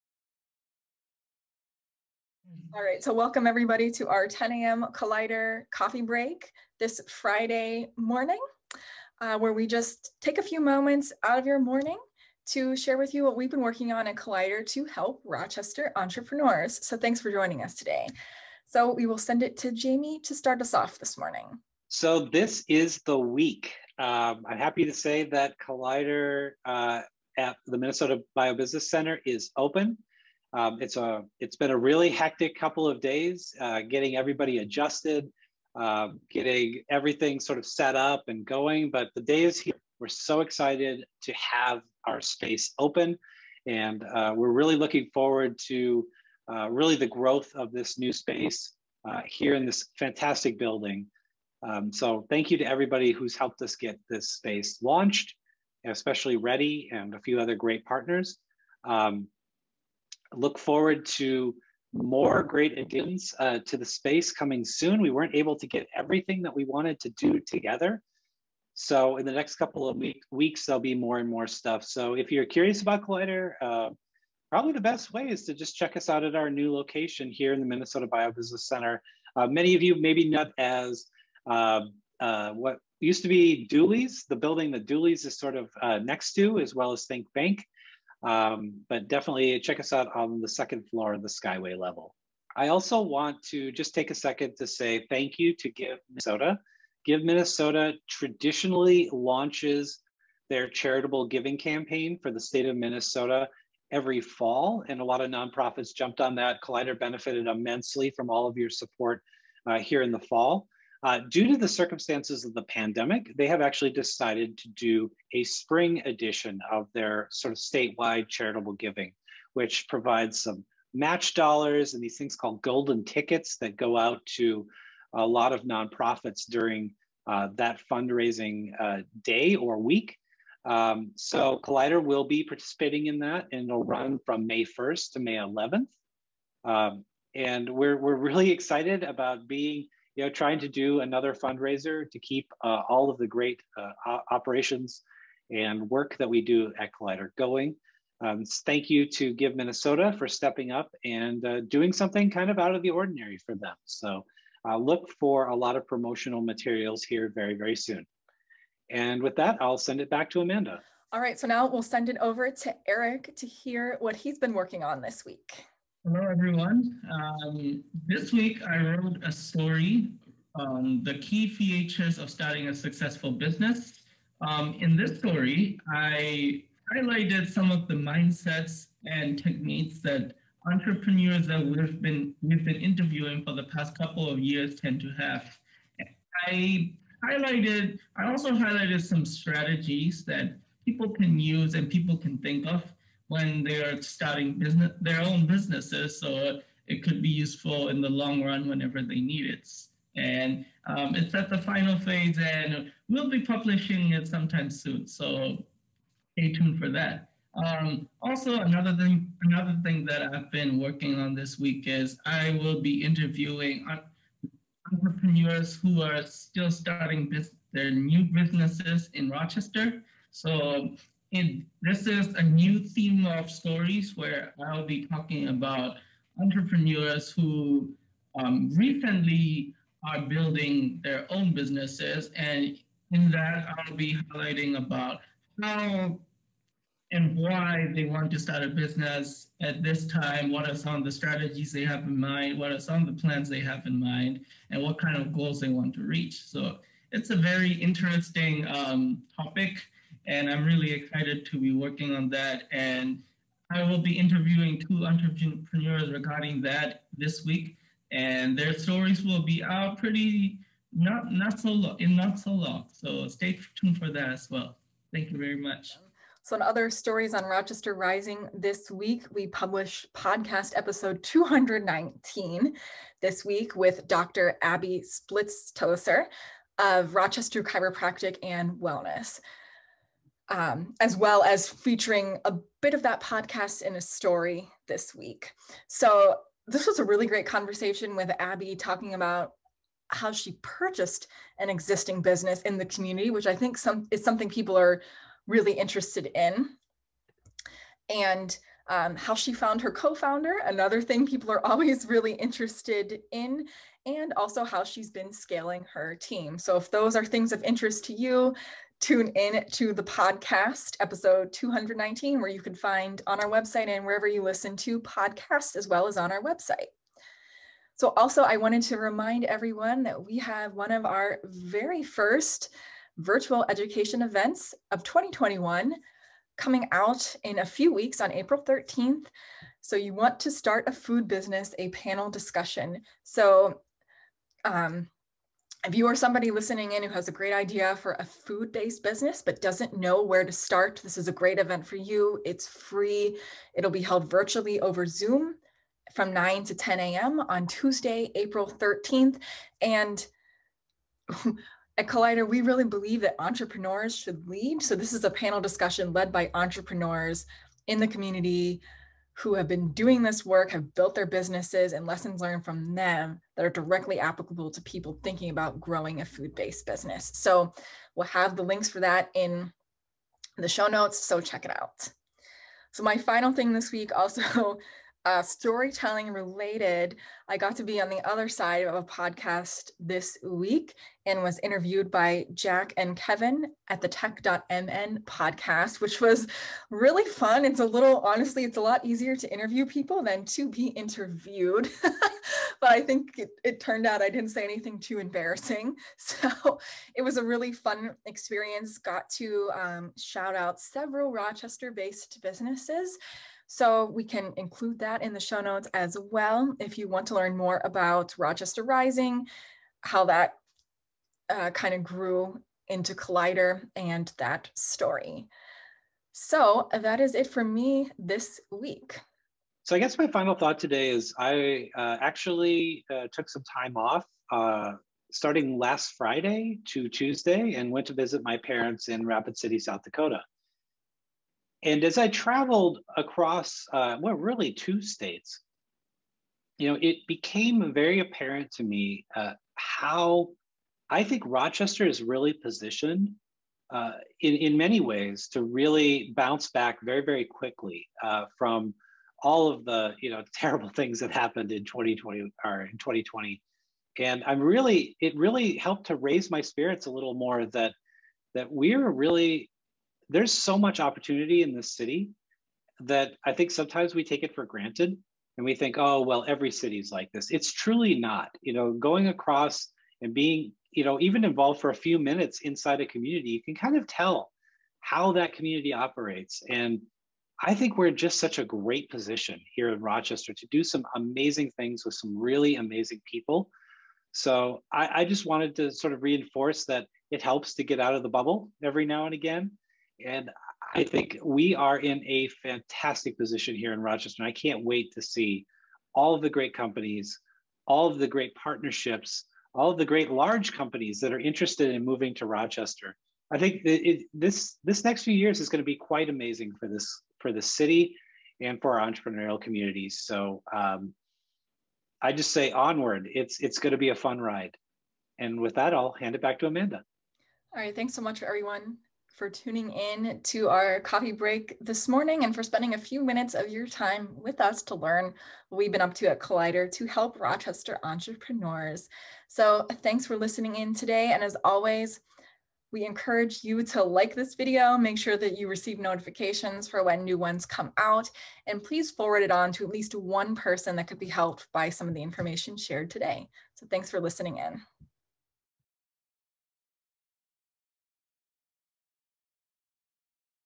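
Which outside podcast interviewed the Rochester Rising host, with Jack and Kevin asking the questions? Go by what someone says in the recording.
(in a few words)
tech.mn podcast.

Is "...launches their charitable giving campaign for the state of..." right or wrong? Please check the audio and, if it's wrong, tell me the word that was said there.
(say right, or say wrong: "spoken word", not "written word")
right.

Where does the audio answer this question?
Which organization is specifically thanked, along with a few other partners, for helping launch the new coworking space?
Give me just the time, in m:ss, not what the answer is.
0:56.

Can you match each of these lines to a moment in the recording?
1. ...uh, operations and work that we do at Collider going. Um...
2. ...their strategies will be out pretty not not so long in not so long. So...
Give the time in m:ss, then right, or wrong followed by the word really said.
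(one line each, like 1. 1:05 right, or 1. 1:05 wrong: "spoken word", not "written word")
1. 2:23 right
2. 4:18 wrong: "stories", not "strategies".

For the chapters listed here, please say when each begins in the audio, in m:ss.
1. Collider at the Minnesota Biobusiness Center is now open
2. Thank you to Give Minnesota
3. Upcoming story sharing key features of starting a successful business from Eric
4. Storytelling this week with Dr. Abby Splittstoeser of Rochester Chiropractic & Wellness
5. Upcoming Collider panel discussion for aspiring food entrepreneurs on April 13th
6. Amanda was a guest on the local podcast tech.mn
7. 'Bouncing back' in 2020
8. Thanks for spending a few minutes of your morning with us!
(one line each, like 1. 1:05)
1. 0:22
2. 1:33
3. 2:46
4. 4:27
5. 5:18
6. 6:13
7. 7:00
8. 8:37.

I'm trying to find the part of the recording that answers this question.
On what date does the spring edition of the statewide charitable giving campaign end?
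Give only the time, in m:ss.
2:15.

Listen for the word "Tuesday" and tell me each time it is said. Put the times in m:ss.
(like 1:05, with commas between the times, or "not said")
5:47, 7:07.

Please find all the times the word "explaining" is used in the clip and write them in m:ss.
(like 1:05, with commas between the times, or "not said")
not said.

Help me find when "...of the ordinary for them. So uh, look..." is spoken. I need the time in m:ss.
2:32.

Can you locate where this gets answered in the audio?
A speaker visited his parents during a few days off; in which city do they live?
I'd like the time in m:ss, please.
7:09.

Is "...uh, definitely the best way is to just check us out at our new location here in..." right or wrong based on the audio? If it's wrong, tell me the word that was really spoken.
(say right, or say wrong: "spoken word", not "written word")
wrong: "probably", not "definitely".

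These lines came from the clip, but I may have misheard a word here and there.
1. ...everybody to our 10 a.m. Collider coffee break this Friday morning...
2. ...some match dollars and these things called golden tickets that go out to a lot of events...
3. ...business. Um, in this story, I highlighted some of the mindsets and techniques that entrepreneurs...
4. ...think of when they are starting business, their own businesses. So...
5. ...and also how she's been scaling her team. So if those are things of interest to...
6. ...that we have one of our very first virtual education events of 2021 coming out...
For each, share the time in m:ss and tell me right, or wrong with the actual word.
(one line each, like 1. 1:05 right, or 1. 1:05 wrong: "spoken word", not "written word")
1. 0:03 right
2. 2:00 wrong: "nonprofits", not "events"
3. 2:53 right
4. 3:12 right
5. 5:04 right
6. 5:20 right.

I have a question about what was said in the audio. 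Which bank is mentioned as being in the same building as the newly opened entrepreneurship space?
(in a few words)
Think Bank.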